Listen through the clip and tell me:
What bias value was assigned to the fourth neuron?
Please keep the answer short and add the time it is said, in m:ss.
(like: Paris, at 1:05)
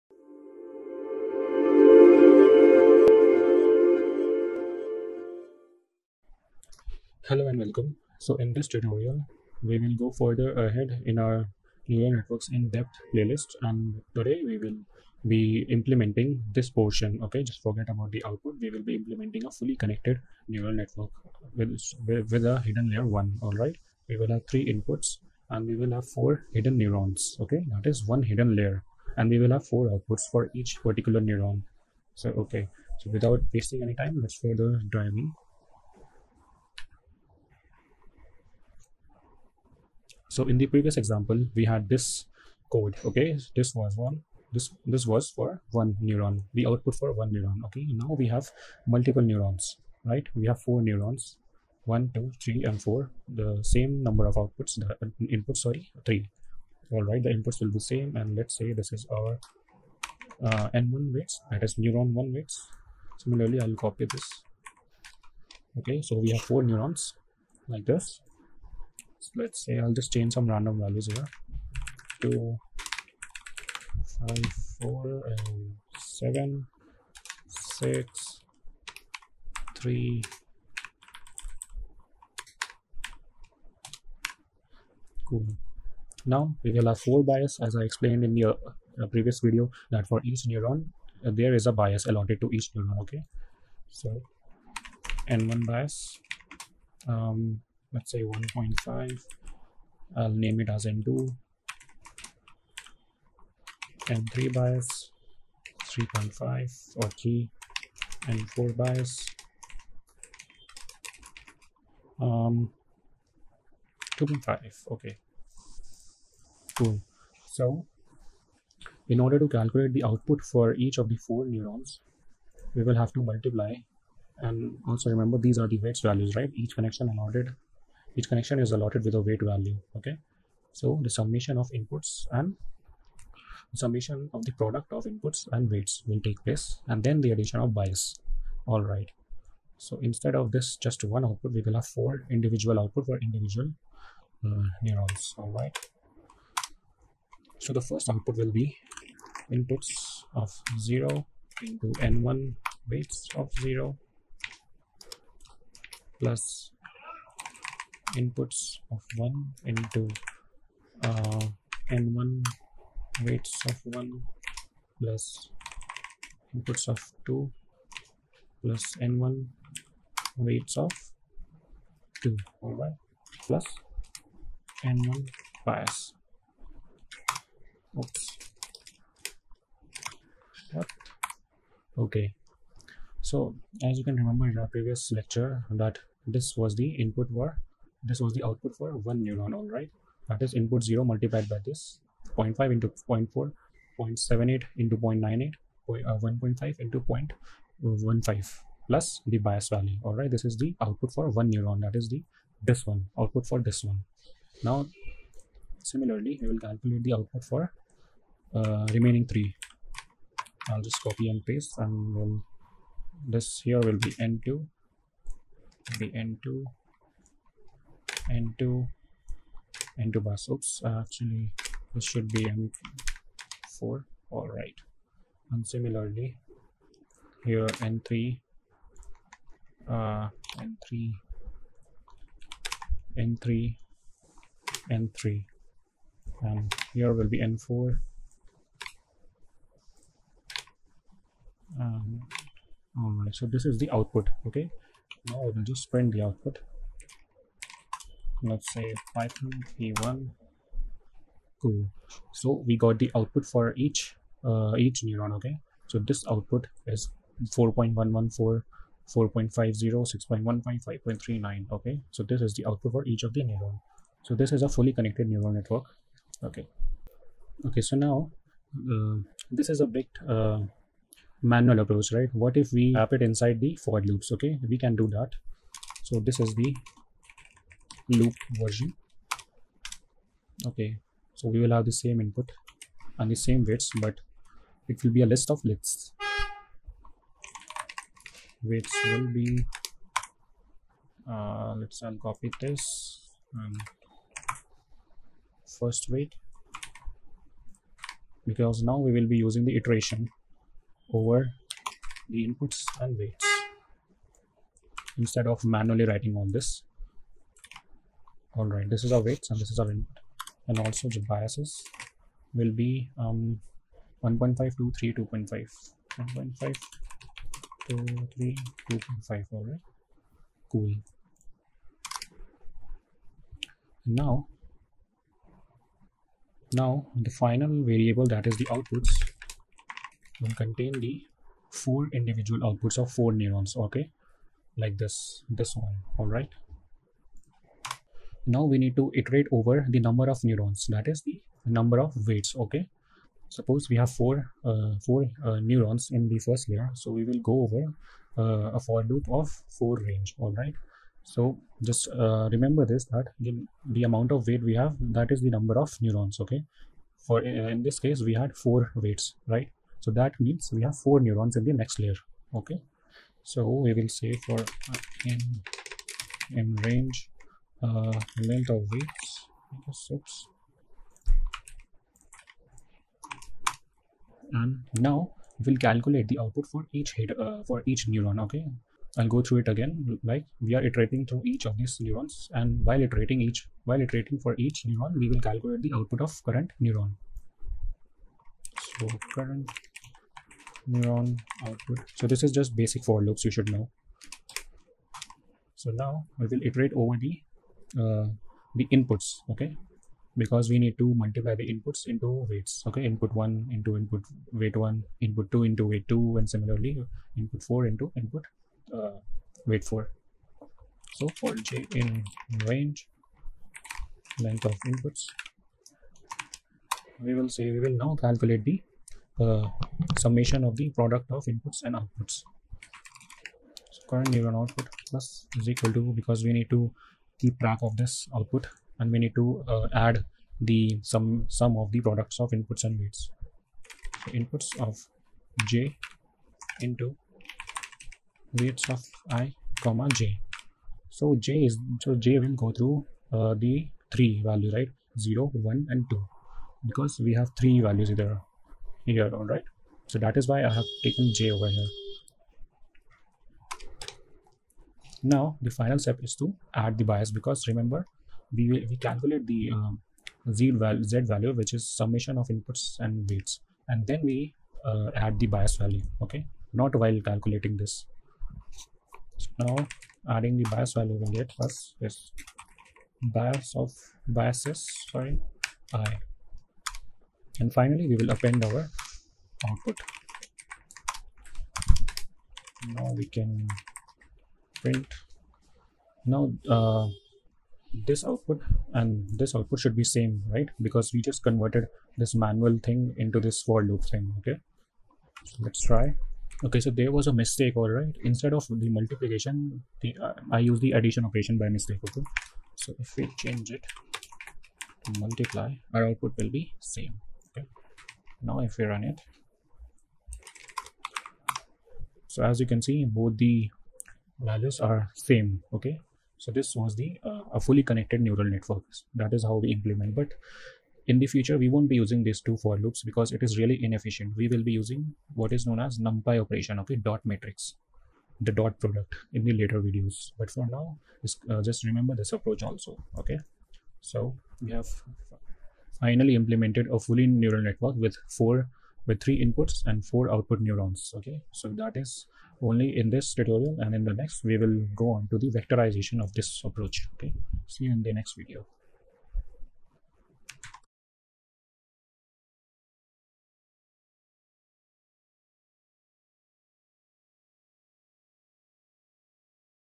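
2.5, at 1:48.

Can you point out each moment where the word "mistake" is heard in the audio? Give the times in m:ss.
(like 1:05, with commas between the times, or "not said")
8:17, 8:21.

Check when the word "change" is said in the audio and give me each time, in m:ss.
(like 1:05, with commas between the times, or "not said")
1:10, 8:23.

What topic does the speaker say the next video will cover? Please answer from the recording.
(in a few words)
vectorization.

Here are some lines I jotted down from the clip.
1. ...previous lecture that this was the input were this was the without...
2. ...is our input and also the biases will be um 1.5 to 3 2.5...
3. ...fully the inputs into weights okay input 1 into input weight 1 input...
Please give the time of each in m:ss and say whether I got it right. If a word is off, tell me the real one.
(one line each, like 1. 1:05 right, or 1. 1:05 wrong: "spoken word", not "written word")
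1. 3:04 wrong: "output", not "without"
2. 5:09 right
3. 6:41 wrong: "multiply", not "fully".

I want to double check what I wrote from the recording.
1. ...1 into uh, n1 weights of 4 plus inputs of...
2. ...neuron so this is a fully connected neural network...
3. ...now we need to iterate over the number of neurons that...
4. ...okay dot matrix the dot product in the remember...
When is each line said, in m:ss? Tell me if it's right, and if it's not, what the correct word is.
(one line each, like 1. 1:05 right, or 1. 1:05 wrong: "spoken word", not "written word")
1. 2:39 wrong: "1", not "4"
2. 4:23 right
3. 5:38 right
4. 8:46 wrong: "later", not "remember".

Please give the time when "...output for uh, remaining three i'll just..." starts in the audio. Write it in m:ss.
3:27.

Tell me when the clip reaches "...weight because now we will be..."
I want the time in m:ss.
4:56.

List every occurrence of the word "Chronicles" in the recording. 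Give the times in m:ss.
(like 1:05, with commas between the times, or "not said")
not said.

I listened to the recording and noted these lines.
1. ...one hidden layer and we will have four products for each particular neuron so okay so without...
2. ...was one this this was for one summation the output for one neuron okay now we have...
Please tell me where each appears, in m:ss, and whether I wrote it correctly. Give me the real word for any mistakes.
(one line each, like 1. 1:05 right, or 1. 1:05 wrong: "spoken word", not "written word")
1. 0:28 wrong: "outputs", not "products"
2. 0:43 wrong: "neuron", not "summation".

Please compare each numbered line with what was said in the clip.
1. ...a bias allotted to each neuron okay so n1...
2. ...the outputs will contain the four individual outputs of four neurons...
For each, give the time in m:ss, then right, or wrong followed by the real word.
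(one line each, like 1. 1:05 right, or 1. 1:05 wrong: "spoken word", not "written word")
1. 1:31 right
2. 5:28 right.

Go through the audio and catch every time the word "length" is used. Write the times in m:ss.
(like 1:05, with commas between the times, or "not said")
6:08, 6:54.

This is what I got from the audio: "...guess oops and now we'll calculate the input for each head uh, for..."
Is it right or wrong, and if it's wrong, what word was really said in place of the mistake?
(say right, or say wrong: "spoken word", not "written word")
wrong: "output", not "input".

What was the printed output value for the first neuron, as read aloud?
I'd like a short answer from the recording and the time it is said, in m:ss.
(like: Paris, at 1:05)
4.114, at 4:17.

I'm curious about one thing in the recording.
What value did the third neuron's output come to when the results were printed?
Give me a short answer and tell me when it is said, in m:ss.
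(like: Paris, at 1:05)
6.15, at 4:20.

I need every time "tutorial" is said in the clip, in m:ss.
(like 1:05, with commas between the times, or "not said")
0:08, 9:03.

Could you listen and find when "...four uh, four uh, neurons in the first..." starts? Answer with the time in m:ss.
5:44.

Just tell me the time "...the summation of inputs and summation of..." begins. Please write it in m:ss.
2:11.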